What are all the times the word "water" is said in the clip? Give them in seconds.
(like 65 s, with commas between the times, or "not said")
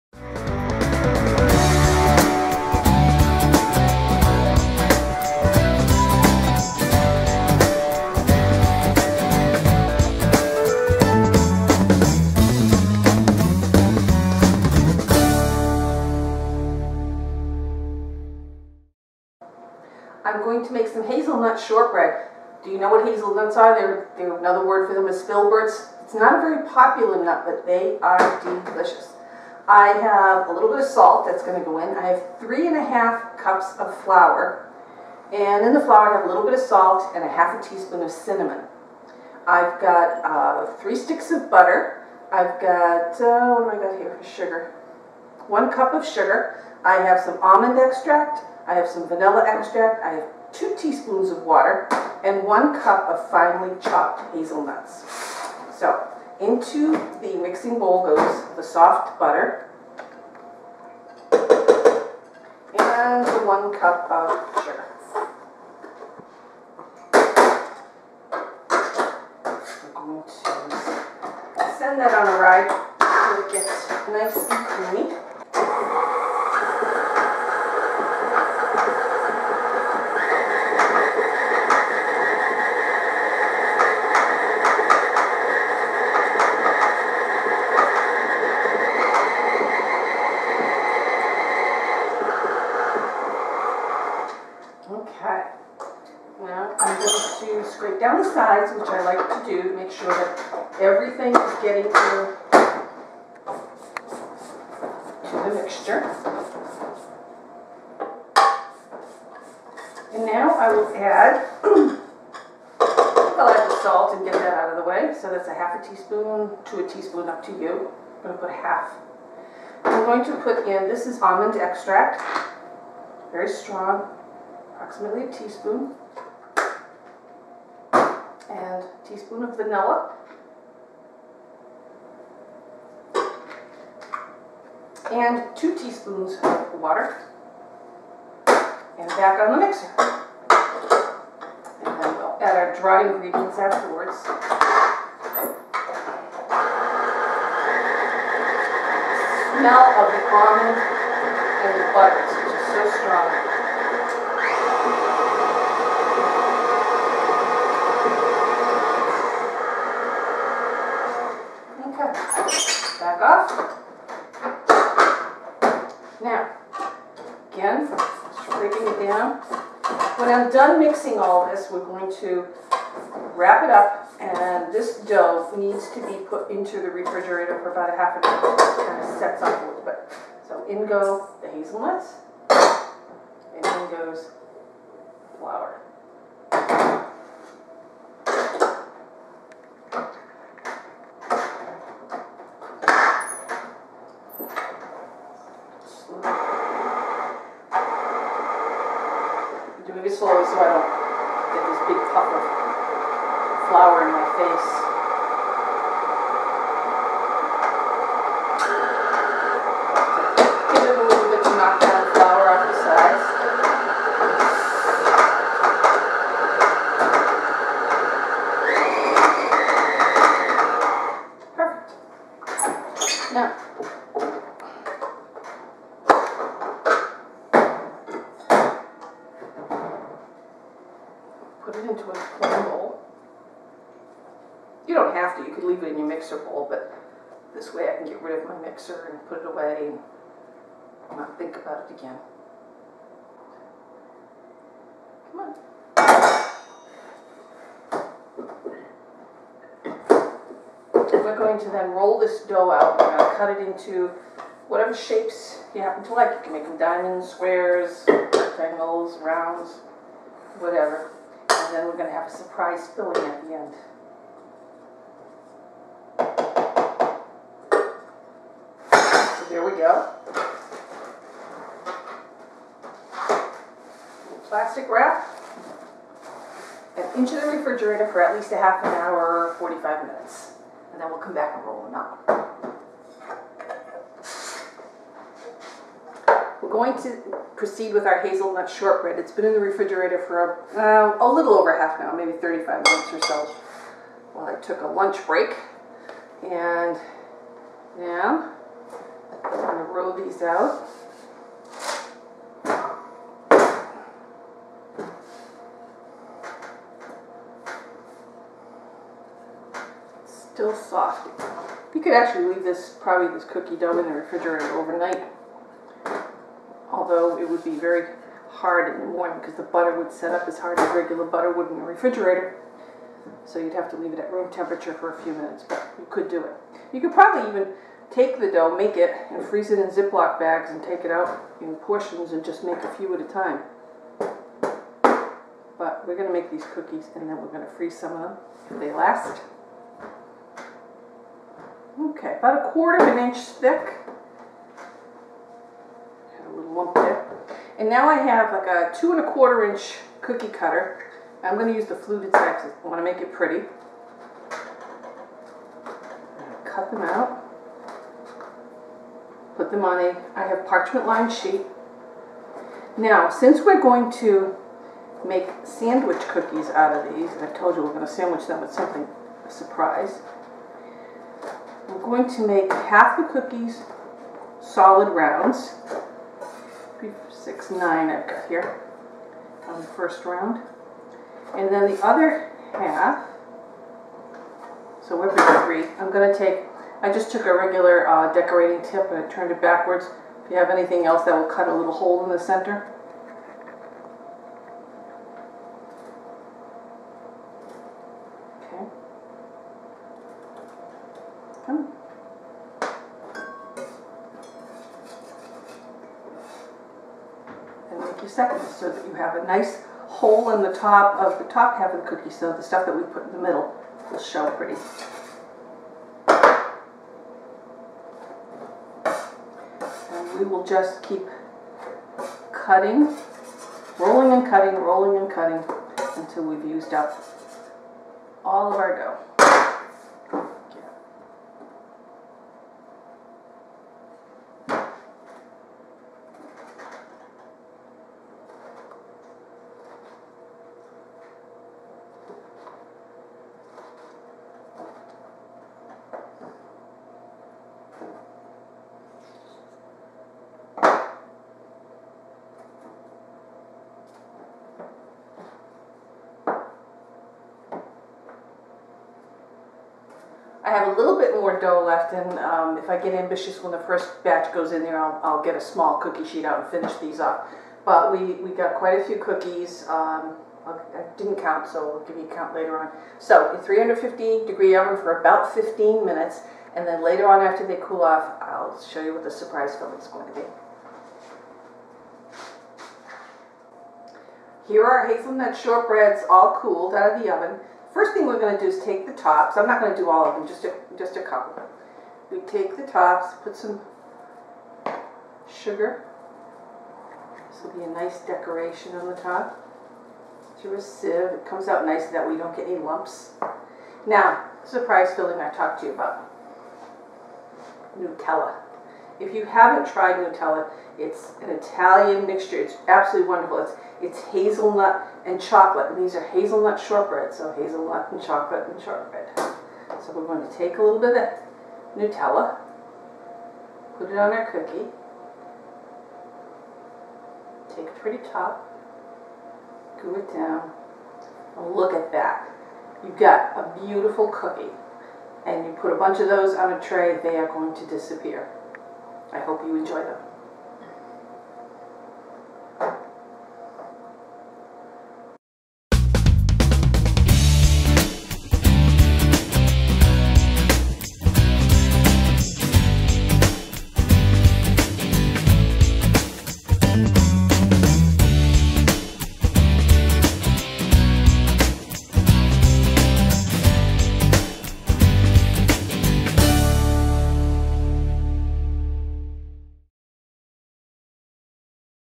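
51 s, 136 s.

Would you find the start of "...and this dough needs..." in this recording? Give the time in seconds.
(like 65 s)
174 s.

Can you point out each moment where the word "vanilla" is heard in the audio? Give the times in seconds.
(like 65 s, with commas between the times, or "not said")
49 s, 129 s.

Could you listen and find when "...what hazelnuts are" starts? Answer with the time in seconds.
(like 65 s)
22 s.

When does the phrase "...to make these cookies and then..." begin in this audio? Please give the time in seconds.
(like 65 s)
336 s.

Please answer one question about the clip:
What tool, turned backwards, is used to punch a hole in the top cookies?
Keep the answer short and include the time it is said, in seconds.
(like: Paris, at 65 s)
decorating tip, at 388 s.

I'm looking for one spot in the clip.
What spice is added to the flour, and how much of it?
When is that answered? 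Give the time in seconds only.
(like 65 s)
37 s.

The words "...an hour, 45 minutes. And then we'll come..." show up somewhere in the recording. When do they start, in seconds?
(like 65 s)
278 s.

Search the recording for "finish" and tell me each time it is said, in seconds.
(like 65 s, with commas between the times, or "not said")
466 s.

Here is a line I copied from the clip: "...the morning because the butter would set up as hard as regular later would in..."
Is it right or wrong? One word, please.
wrong.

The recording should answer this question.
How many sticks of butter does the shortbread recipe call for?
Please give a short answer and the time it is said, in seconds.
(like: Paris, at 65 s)
3, at 40 s.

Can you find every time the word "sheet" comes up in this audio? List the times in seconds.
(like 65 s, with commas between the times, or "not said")
361 s, 466 s.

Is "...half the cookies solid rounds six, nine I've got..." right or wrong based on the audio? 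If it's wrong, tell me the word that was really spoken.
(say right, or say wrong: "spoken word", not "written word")
right.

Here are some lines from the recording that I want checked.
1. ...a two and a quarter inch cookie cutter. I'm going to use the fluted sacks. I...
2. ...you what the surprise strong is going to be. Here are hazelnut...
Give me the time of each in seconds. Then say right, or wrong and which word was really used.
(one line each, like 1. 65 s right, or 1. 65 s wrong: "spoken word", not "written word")
1. 348 s right
2. 479 s wrong: "filling", not "strong".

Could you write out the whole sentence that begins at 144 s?
The smell of the almond and the butter is just so strong.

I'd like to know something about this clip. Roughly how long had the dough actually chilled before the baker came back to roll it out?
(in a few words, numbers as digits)
35 minutes.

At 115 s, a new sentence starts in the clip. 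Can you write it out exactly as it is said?
So that's a half a teaspoon to a teaspoon, up to you.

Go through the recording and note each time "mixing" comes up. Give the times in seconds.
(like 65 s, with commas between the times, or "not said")
57 s, 170 s.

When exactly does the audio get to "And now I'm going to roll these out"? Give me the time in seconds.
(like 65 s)
296 s.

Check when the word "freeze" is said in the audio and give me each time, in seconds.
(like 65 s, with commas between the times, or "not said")
329 s, 337 s.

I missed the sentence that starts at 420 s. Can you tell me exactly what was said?
And we will just keep cutting, rolling and cutting, rolling and cutting until we've used up all of our dough.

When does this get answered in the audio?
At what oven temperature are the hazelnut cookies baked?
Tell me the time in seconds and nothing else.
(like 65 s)
473 s.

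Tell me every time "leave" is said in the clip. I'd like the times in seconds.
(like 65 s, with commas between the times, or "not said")
235 s, 312 s, 323 s.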